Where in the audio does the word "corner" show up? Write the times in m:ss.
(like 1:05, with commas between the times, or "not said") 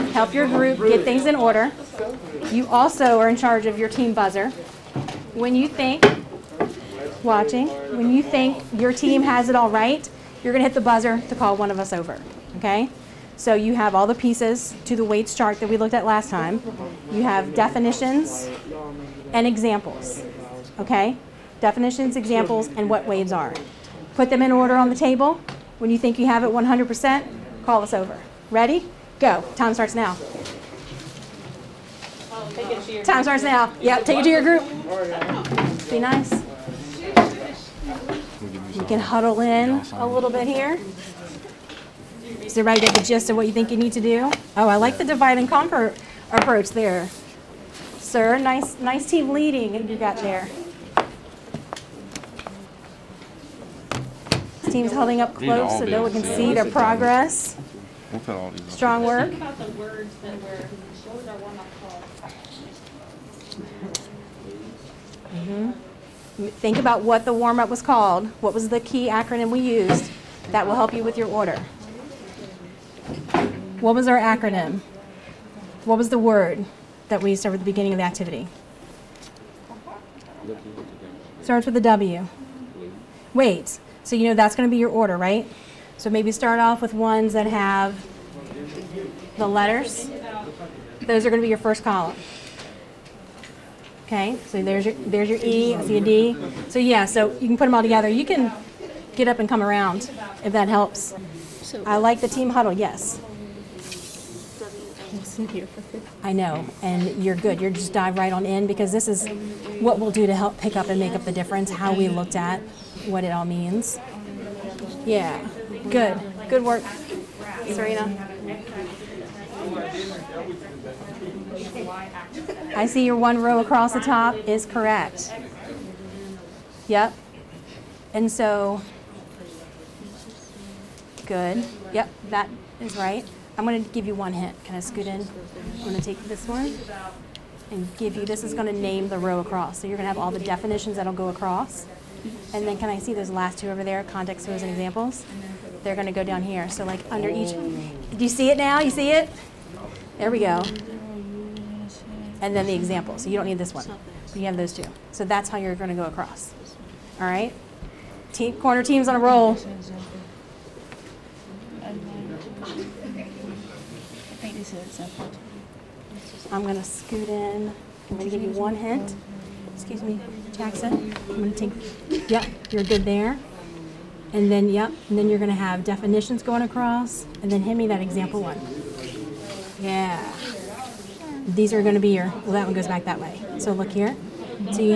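2:38.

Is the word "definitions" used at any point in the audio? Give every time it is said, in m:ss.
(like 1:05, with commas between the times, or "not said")
0:17, 0:21, 2:20, 2:55.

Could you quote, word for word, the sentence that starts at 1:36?
So yeah, so you can put them all together.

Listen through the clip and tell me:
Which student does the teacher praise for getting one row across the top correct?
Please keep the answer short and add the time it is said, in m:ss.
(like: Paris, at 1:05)
Serena, at 1:57.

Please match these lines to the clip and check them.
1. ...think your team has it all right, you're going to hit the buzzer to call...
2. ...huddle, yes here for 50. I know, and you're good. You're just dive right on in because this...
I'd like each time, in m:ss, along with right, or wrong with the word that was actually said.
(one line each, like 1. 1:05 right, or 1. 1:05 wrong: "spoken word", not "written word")
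1. 0:08 right
2. 1:42 right.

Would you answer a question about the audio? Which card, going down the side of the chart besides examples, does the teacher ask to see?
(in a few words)
context clues.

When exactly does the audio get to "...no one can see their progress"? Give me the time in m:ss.
0:55.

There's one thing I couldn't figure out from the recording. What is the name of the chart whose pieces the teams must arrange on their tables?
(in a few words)
WADES chart.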